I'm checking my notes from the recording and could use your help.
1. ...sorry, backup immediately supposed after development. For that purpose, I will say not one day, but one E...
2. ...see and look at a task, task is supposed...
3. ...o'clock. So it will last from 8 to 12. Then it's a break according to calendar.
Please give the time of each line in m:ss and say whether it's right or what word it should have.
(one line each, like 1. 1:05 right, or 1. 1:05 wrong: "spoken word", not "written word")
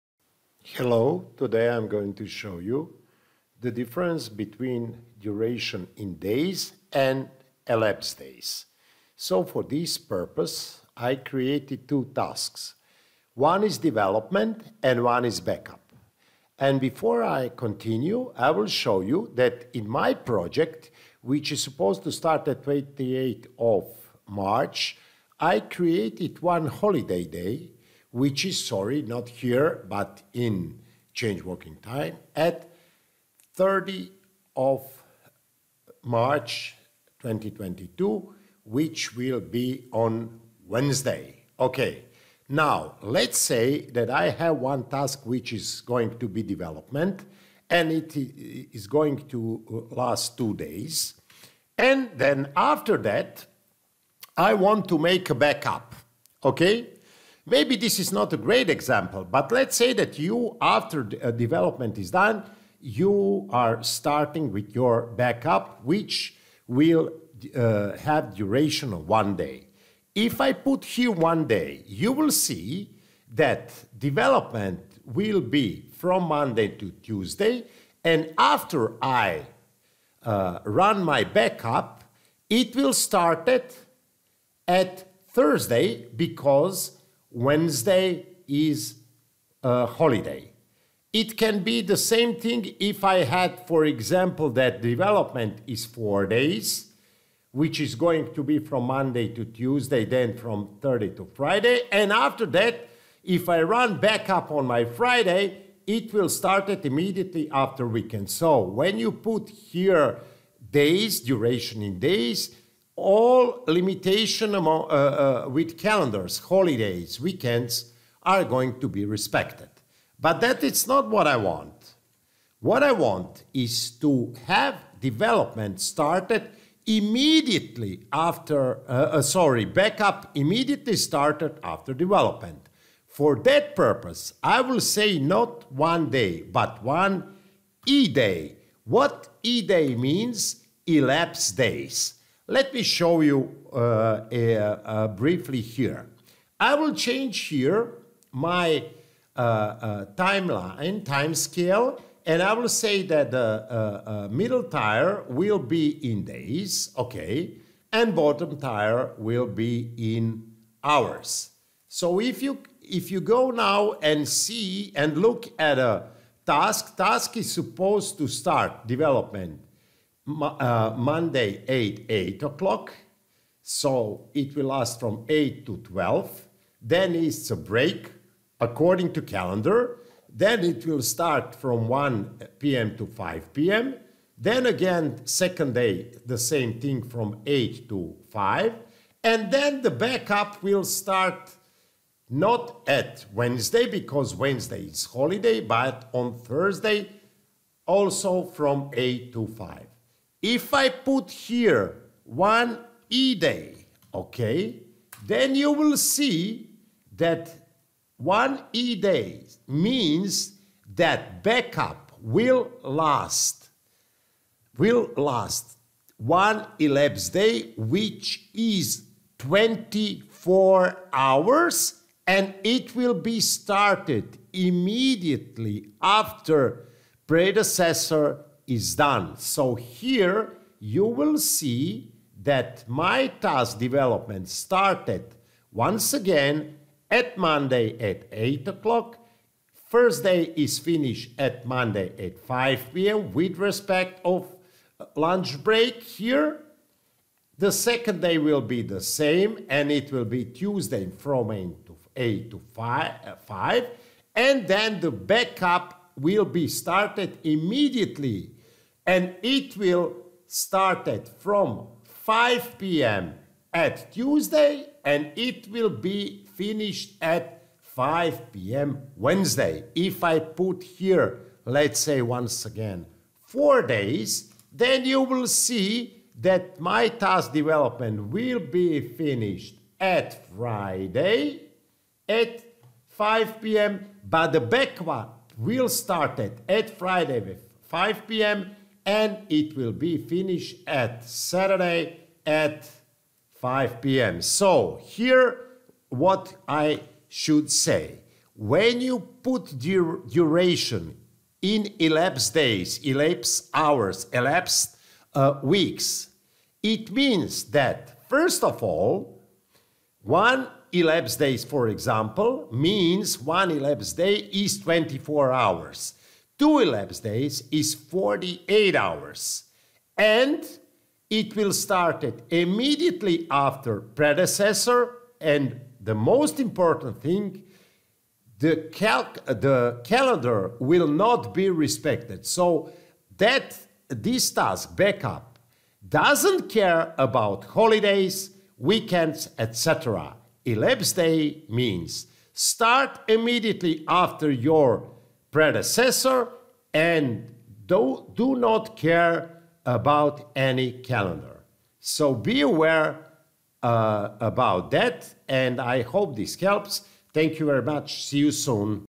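1. 2:09 wrong: "started", not "supposed"
2. 2:44 right
3. 2:52 right.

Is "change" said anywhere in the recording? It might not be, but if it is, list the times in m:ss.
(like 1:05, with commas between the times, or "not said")
0:31, 2:26.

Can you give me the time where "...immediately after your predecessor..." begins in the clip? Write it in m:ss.
5:43.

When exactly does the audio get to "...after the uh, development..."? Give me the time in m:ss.
1:00.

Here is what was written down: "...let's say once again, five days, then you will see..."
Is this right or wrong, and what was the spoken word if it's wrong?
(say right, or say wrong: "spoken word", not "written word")
wrong: "four", not "five".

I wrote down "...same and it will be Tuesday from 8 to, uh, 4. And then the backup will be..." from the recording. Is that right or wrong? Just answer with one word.
wrong.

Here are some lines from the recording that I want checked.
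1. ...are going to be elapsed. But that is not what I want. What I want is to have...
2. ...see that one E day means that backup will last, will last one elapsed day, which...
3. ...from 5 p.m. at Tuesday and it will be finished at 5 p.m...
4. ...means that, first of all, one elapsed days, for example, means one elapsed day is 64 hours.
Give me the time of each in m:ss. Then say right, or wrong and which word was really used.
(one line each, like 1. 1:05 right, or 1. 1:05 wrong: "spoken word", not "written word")
1. 1:58 wrong: "respected", not "elapsed"
2. 3:25 right
3. 4:21 right
4. 5:07 wrong: "24", not "64".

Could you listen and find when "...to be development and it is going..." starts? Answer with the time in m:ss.
0:46.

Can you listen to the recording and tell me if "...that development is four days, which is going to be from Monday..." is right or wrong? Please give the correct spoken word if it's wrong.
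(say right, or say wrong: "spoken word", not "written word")
right.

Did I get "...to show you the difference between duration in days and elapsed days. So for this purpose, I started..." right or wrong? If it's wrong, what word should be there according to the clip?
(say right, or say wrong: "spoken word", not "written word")
wrong: "created", not "started".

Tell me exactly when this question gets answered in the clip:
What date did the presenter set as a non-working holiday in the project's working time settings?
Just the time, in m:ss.
0:33.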